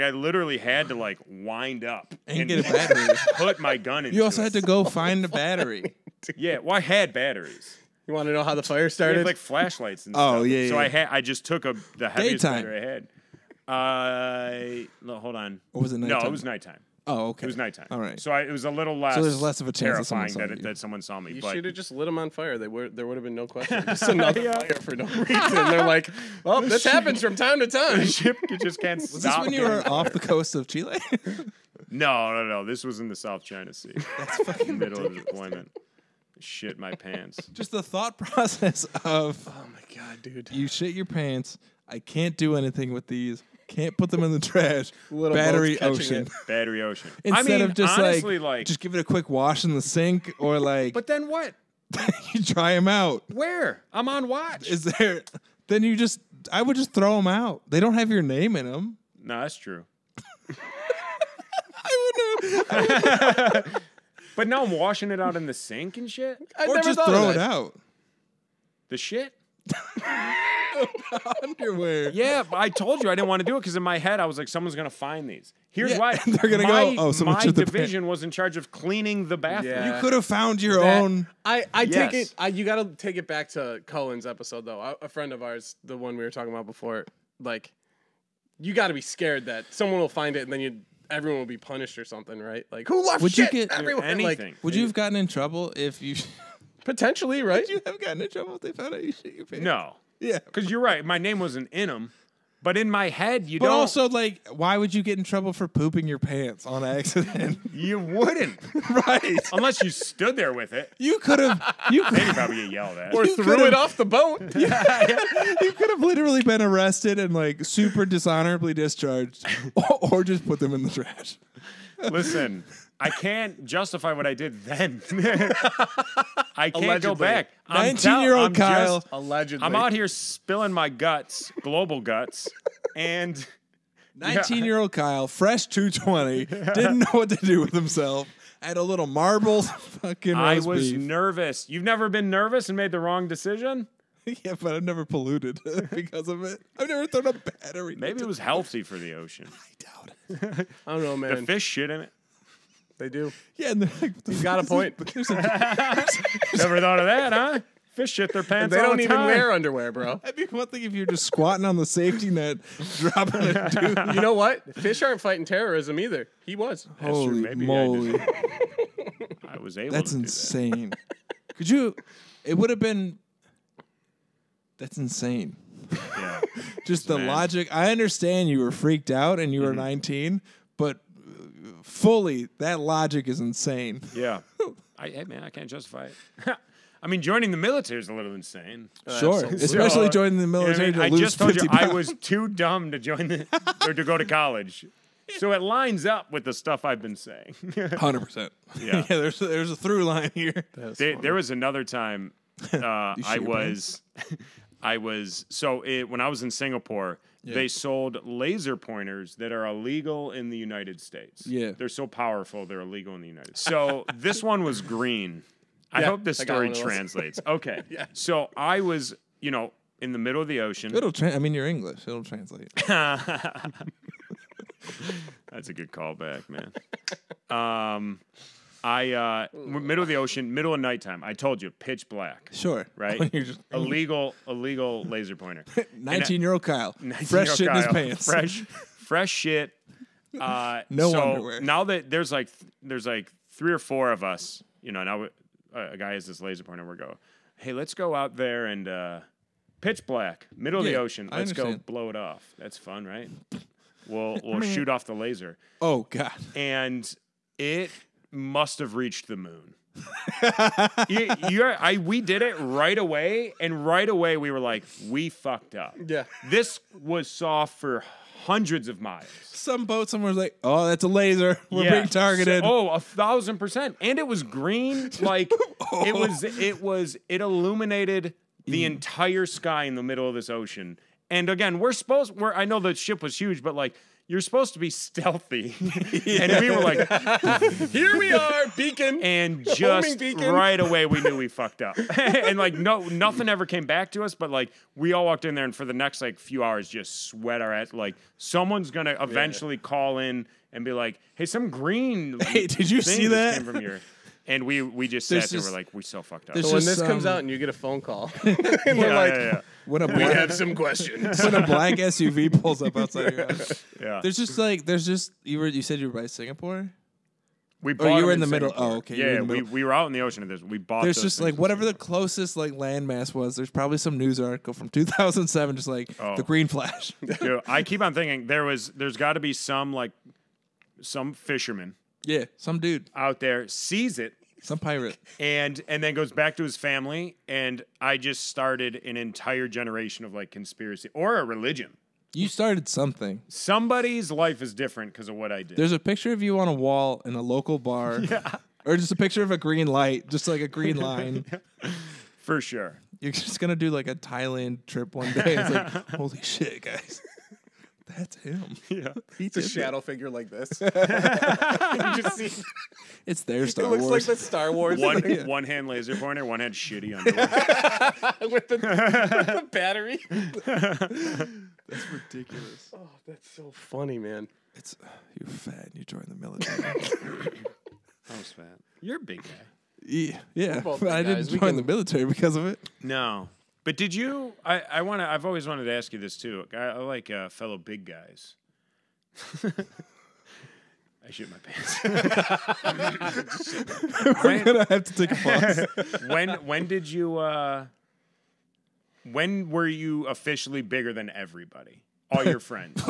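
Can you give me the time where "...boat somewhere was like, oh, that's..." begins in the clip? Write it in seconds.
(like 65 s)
269 s.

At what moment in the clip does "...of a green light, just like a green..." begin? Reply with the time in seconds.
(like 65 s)
349 s.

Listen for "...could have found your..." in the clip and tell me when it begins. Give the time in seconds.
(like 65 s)
80 s.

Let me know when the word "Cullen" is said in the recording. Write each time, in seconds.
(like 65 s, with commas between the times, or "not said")
83 s.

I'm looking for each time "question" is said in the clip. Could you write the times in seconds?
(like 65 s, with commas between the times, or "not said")
23 s, 310 s.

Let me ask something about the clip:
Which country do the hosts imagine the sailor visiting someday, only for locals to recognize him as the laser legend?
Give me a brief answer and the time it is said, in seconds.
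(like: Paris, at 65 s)
Thailand, at 354 s.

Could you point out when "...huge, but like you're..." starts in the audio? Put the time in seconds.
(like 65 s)
283 s.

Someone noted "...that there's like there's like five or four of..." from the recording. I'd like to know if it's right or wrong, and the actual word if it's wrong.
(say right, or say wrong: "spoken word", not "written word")
wrong: "three", not "five".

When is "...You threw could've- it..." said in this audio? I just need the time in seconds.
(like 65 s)
113 s.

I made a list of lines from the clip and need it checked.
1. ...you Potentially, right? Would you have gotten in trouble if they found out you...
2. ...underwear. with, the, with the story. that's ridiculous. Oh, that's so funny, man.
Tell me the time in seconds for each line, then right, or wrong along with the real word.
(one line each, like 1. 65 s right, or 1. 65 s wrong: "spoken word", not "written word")
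1. 96 s right
2. 367 s wrong: "battery", not "story".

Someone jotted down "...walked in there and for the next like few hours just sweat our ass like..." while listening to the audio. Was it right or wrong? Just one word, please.
right.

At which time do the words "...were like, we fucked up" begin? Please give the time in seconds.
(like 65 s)
264 s.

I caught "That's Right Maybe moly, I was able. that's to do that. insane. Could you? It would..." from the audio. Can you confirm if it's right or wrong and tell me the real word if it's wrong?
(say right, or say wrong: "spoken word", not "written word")
wrong: "Holy", not "Right".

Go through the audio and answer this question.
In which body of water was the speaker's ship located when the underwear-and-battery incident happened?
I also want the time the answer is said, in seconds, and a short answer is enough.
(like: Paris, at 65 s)
South China Sea, at 33 s.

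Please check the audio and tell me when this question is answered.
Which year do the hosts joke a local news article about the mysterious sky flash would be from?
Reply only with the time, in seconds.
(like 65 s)
324 s.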